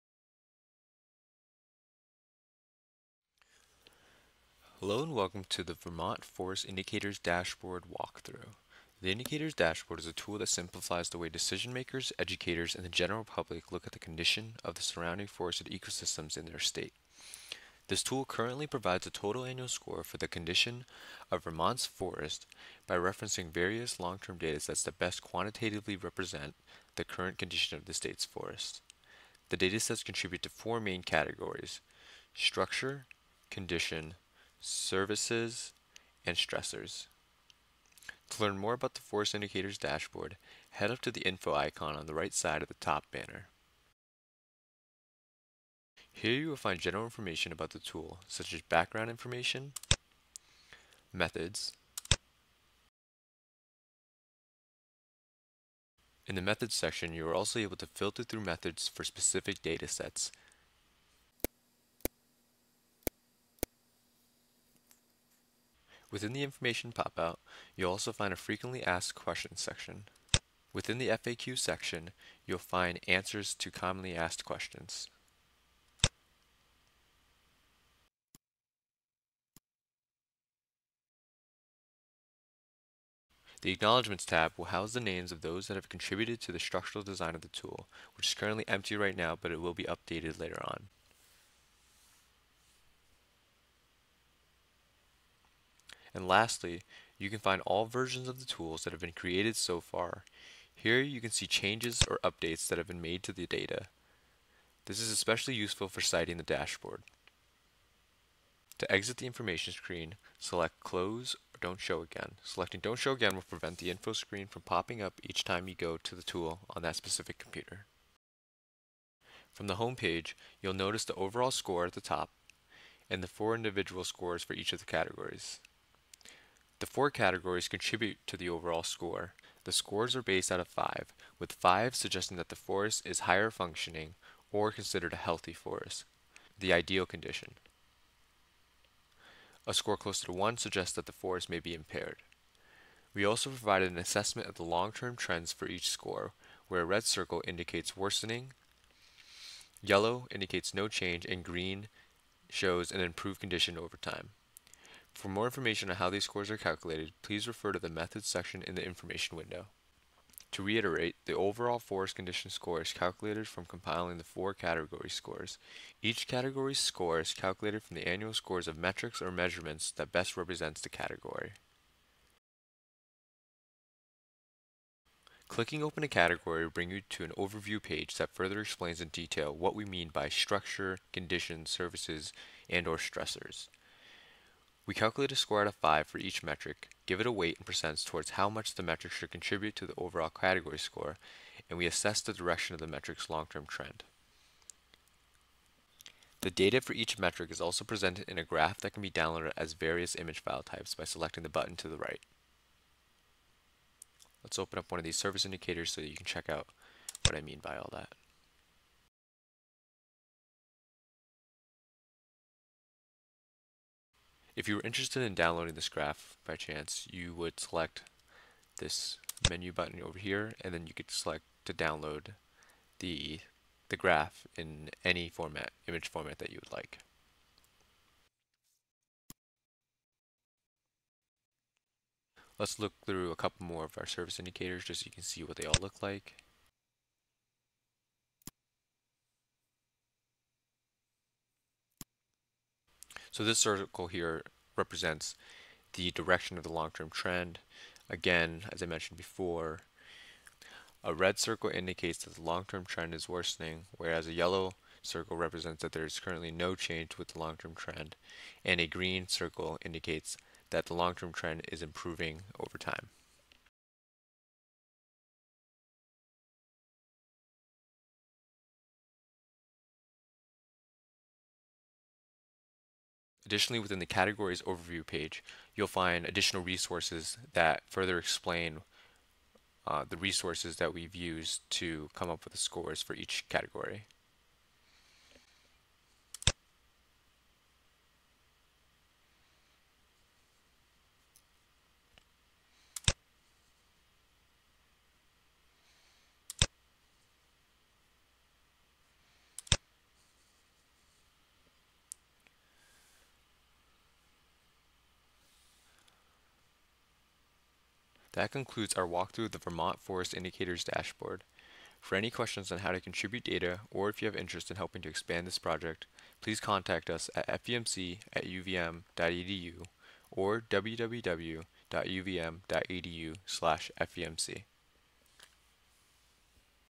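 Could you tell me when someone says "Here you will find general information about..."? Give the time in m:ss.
0:46.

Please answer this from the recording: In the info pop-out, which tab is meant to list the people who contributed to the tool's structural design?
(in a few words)
Acknowledgements.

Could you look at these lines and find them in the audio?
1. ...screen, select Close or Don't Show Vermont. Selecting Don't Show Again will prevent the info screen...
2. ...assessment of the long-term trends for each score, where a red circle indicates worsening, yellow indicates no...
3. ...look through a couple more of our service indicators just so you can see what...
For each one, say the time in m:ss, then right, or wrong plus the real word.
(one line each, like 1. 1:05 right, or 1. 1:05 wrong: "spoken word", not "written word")
1. 1:49 wrong: "Again", not "Vermont"
2. 2:23 right
3. 3:52 right.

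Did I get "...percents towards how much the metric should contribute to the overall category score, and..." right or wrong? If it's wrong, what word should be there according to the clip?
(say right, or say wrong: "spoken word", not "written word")
right.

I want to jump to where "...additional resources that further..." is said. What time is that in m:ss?
4:36.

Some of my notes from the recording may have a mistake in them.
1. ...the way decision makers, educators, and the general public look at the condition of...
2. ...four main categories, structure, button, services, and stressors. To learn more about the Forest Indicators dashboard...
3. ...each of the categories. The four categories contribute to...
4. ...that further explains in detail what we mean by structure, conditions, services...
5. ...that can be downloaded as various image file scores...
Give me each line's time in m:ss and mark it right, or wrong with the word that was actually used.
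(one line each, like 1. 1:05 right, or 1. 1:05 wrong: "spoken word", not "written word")
1. 0:11 right
2. 0:30 wrong: "condition", not "button"
3. 2:04 right
4. 2:58 right
5. 3:18 wrong: "types", not "scores".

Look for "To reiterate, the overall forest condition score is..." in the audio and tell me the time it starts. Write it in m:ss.
2:40.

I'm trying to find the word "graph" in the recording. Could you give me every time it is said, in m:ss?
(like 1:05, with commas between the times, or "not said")
3:18, 3:35, 3:43.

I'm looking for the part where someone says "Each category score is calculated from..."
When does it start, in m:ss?
2:46.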